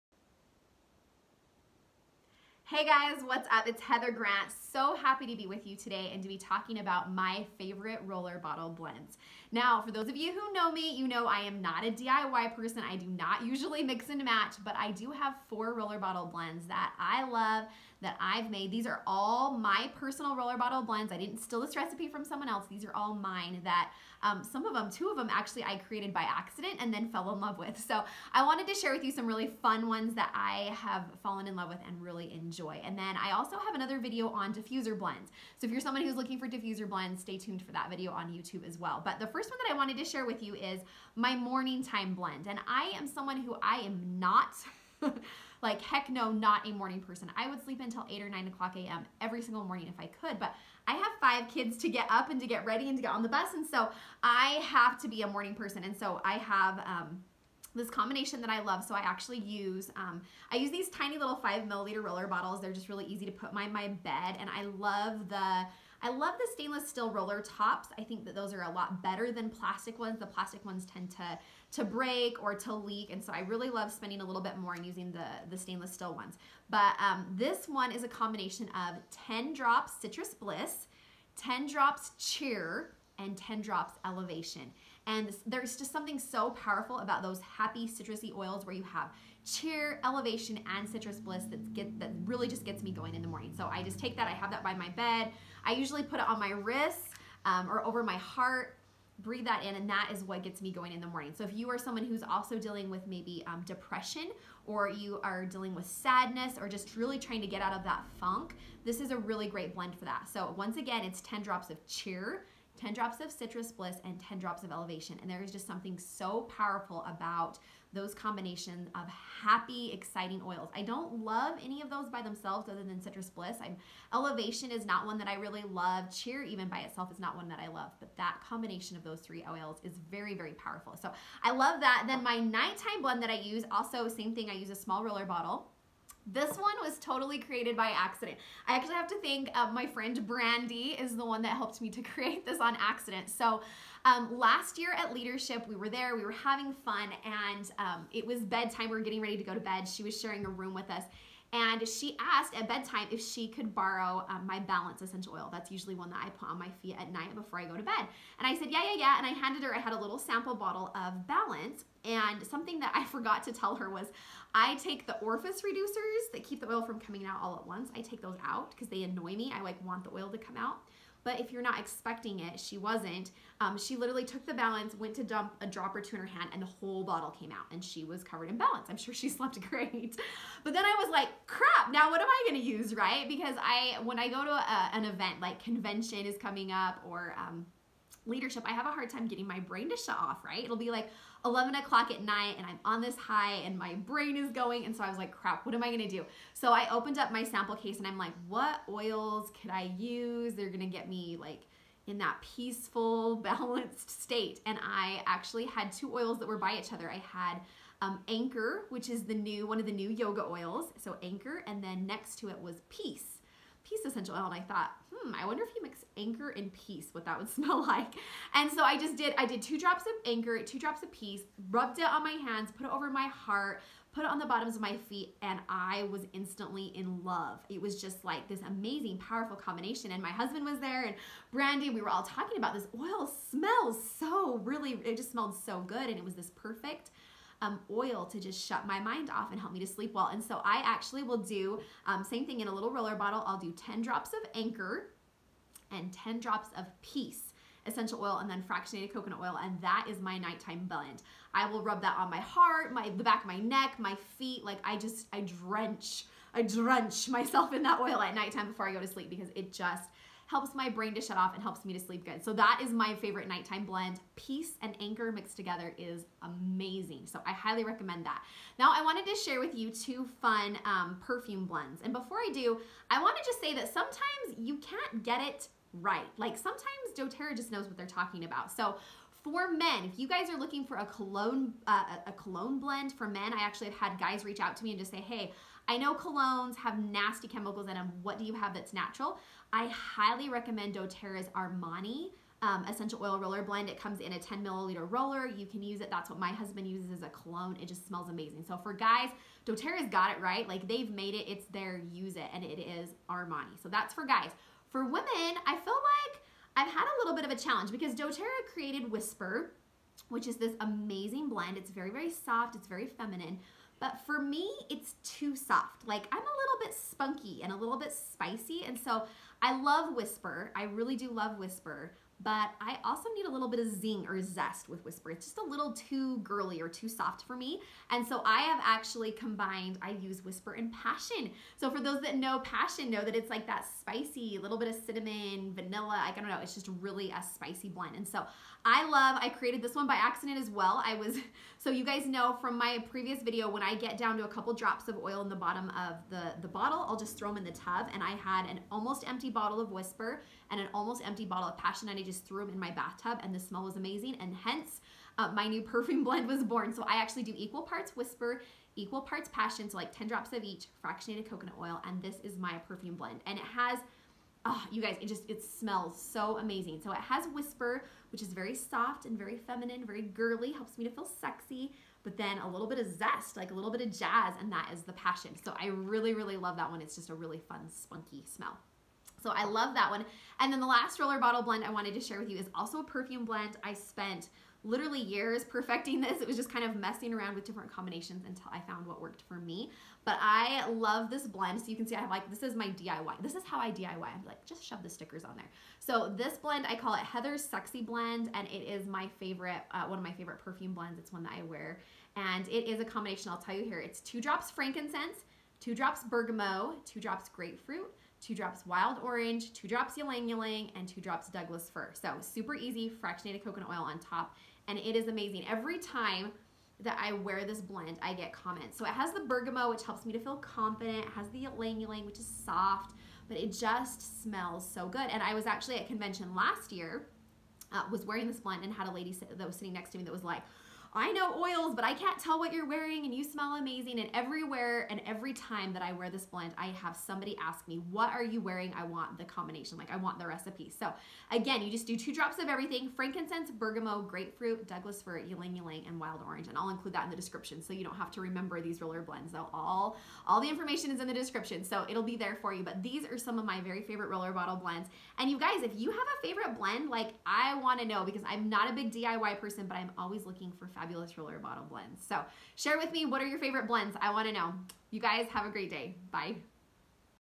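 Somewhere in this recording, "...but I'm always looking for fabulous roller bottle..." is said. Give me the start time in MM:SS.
07:39.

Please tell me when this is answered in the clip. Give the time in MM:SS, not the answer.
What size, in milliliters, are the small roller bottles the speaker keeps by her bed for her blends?
01:01.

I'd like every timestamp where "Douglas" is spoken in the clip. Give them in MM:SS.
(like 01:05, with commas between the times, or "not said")
06:51, 07:24.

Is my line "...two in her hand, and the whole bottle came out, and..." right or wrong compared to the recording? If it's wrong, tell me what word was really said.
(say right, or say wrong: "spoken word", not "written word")
right.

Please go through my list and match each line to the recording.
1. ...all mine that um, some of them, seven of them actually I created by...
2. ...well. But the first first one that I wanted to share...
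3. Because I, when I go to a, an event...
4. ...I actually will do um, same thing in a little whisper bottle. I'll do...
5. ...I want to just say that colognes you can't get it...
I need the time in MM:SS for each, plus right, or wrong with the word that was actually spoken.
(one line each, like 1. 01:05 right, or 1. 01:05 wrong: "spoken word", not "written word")
1. 00:22 wrong: "two", not "seven"
2. 00:38 right
3. 03:03 right
4. 04:00 wrong: "roller", not "whisper"
5. 04:33 wrong: "sometimes", not "colognes".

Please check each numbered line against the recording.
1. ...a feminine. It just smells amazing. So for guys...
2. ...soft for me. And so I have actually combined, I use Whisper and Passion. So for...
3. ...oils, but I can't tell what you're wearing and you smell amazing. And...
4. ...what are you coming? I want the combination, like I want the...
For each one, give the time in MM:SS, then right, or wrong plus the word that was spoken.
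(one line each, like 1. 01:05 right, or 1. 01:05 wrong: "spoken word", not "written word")
1. 04:57 wrong: "cologne", not "feminine"
2. 05:27 right
3. 07:11 right
4. 07:18 wrong: "wearing", not "coming".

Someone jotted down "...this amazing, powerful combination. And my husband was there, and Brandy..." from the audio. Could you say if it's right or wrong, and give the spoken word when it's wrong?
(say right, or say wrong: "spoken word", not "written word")
right.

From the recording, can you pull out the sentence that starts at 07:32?
But these are some of my very favorite roller bottle blends.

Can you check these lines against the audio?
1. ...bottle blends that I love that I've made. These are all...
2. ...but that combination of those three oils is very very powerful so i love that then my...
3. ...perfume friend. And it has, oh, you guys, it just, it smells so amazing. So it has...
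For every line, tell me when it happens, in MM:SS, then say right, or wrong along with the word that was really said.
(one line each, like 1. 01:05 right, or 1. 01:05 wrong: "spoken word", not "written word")
1. 00:15 right
2. 02:07 right
3. 06:02 wrong: "blend", not "friend".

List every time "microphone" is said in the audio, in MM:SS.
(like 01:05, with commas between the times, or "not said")
not said.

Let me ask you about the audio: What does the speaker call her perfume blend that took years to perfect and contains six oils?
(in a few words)
Heather's Sexy Blend.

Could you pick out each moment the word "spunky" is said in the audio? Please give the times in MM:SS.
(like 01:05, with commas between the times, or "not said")
05:16, 06:17.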